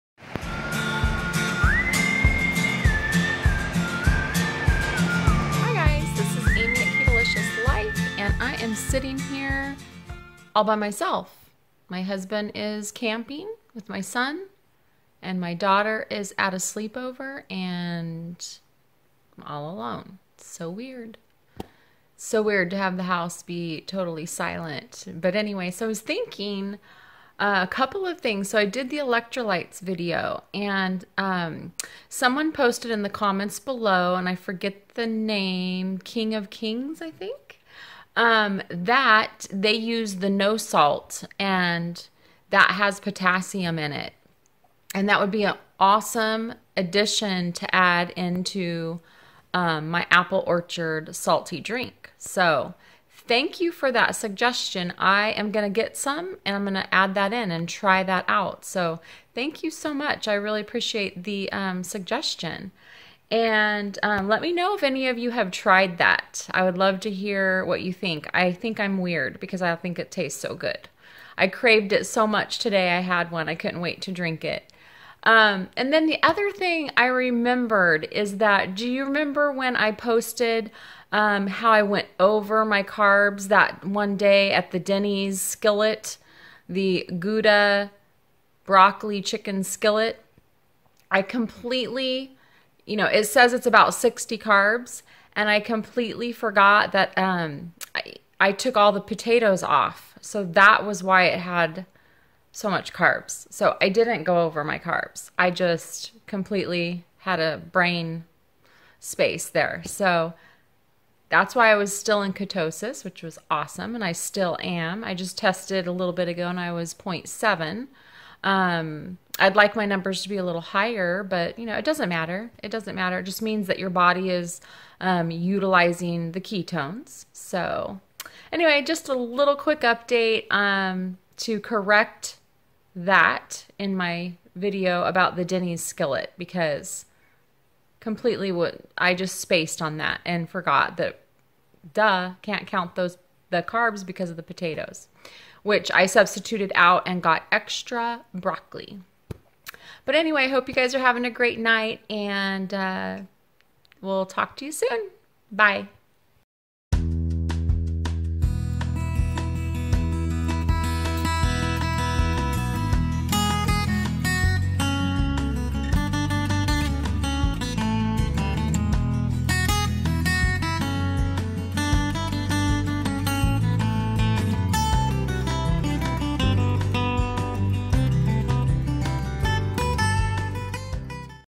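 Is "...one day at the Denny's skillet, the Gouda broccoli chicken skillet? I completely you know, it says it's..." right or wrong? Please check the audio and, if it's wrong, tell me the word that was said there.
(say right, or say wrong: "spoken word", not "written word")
right.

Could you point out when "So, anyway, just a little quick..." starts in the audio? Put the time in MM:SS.
02:07.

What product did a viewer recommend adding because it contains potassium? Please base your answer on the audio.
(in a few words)
No salt.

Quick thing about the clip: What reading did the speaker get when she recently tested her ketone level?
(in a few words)
0.7.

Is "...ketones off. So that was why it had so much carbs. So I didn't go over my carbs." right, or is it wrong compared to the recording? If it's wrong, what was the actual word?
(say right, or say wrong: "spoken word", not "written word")
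wrong: "potatoes", not "ketones".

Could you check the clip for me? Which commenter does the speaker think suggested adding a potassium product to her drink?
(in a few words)
King of Kings.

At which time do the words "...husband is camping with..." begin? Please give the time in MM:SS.
00:12.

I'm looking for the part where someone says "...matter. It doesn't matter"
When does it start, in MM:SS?
02:02.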